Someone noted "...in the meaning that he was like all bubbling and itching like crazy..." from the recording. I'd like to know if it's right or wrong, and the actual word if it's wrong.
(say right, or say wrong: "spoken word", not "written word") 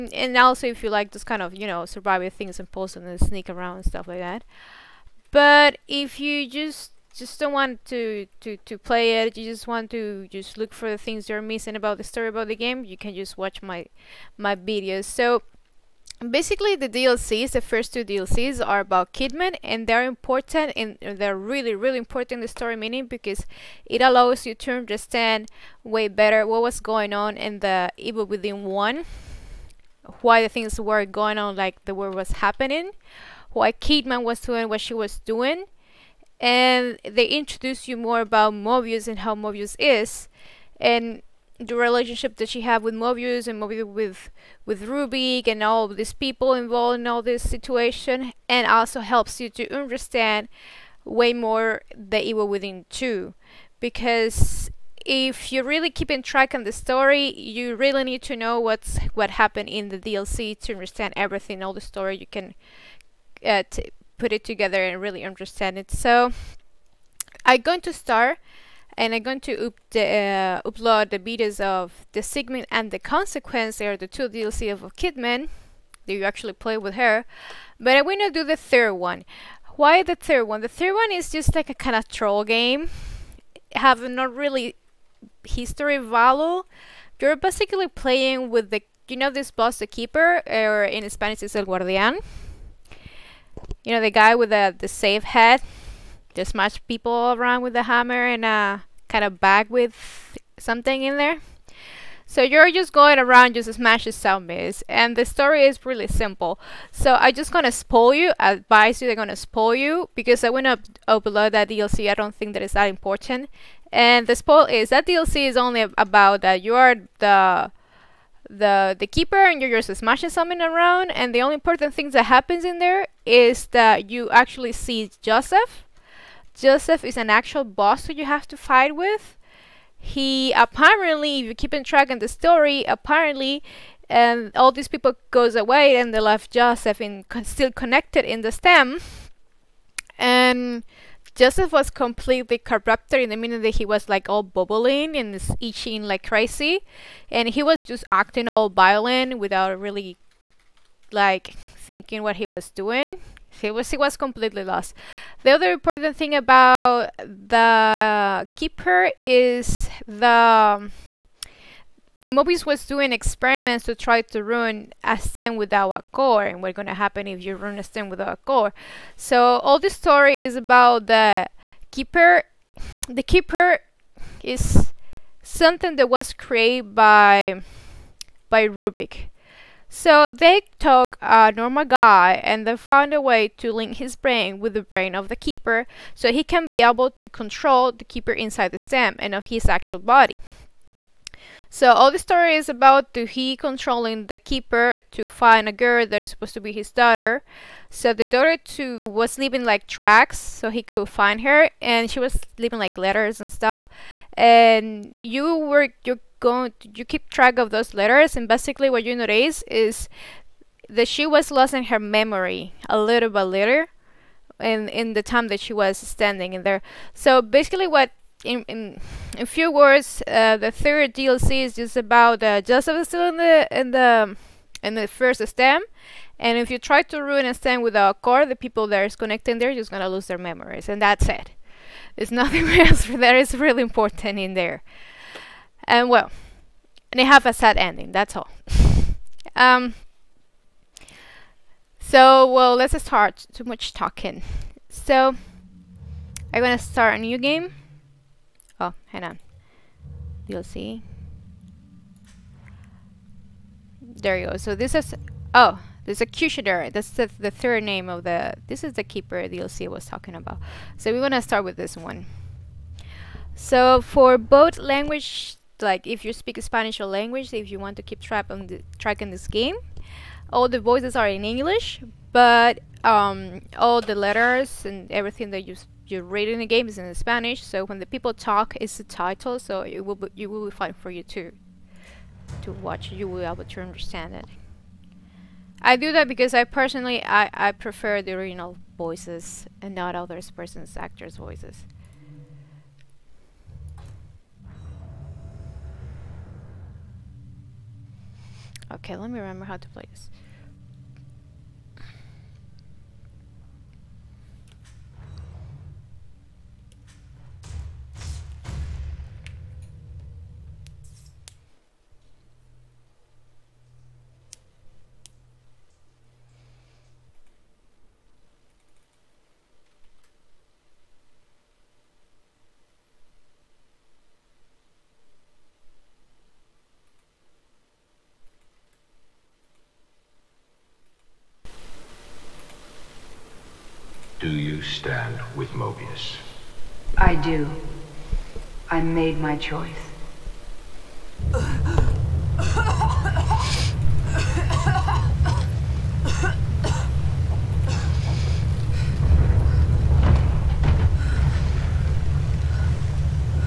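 right.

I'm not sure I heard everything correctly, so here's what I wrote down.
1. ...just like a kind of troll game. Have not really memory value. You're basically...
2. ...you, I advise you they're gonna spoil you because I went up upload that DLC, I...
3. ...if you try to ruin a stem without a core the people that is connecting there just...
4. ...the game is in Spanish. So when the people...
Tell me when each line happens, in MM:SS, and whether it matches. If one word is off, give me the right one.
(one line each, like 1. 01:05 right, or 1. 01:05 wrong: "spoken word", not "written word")
1. 01:21 wrong: "history", not "memory"
2. 01:48 right
3. 03:46 right
4. 04:36 right.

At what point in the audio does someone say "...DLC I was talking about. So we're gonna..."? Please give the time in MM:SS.
04:19.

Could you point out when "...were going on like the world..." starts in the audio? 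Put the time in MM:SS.
00:30.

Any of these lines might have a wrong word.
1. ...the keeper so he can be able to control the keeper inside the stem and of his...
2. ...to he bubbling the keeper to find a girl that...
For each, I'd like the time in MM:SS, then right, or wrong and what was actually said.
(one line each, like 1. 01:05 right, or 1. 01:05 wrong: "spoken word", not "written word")
1. 03:05 right
2. 03:13 wrong: "controlling", not "bubbling".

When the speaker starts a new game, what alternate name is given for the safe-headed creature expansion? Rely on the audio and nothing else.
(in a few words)
The Executioner.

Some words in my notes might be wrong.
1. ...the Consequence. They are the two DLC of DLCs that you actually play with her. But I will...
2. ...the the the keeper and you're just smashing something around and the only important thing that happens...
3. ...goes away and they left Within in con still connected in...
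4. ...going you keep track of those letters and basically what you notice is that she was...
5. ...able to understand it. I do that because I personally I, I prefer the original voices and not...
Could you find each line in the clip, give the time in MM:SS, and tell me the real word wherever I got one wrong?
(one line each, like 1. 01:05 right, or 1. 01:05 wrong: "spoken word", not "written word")
1. 01:12 wrong: "Kidman", not "DLCs"
2. 01:57 right
3. 02:15 wrong: "Joseph", not "Within"
4. 03:26 right
5. 04:43 right.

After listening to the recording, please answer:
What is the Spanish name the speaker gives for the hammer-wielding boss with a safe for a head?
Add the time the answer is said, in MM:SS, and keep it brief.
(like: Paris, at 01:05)
el guardián, at 01:31.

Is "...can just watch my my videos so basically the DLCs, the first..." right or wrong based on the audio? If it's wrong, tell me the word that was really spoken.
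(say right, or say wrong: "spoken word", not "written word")
right.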